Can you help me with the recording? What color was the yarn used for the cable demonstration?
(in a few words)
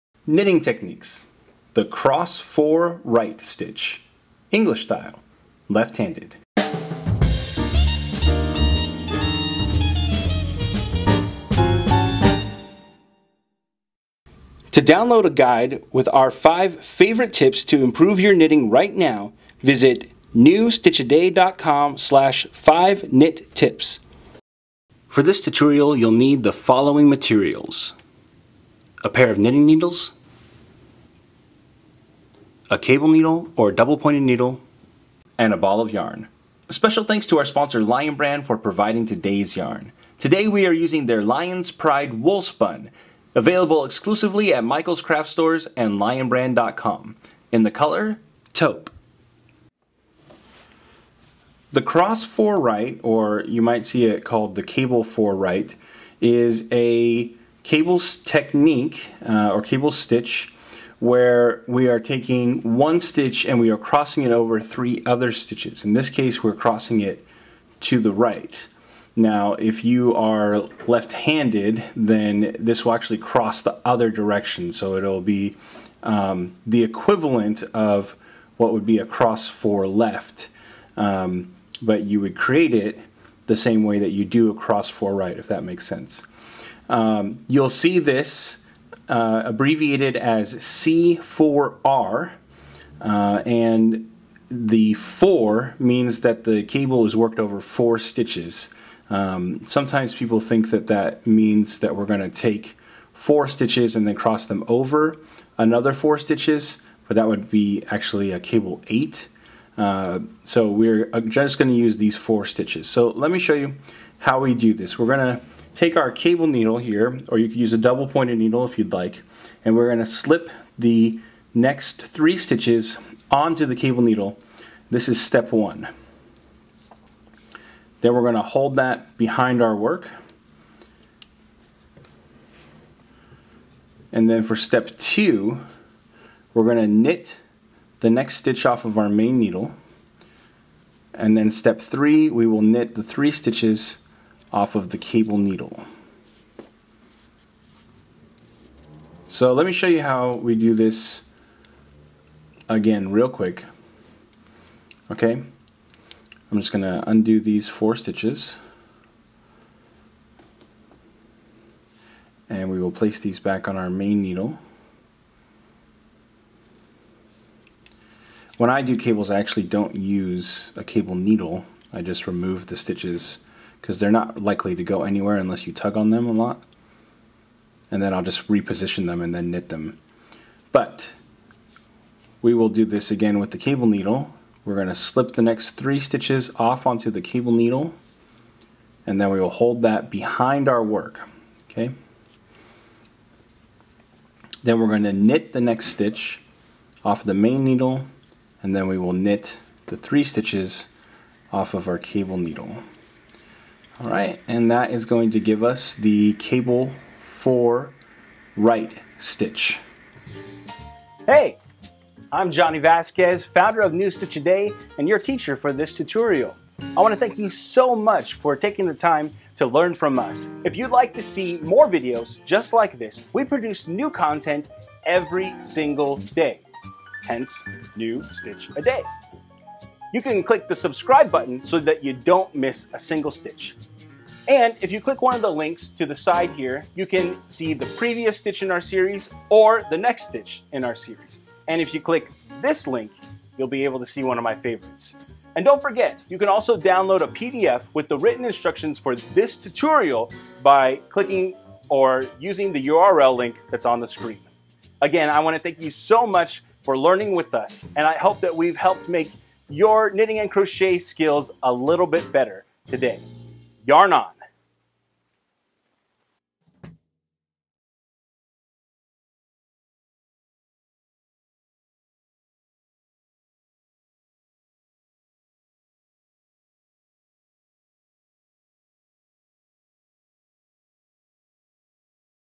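taupe.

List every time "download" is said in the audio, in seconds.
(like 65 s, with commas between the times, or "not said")
14 s, 246 s.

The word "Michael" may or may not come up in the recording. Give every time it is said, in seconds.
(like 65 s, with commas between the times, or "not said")
44 s.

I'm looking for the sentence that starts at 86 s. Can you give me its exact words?
Um, you'll see this uh, abbreviated as C4R, uh, and the four means that the cable is worked over four stitches.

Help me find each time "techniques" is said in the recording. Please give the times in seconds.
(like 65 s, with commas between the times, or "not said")
0 s, 57 s.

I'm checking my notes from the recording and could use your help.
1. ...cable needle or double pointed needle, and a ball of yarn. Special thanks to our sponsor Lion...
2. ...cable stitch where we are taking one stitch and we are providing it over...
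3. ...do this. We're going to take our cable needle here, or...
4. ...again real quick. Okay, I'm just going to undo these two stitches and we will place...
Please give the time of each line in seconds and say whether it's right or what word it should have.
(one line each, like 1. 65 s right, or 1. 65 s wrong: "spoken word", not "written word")
1. 32 s right
2. 59 s wrong: "crossing", not "providing"
3. 114 s right
4. 152 s wrong: "four", not "two".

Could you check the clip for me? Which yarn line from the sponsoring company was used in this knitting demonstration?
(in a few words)
Lion's Pride Woolspun.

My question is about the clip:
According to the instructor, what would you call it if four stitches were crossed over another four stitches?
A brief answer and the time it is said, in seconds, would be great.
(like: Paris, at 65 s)
cable eight, at 108 s.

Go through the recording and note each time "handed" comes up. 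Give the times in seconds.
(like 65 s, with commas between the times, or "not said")
5 s, 70 s.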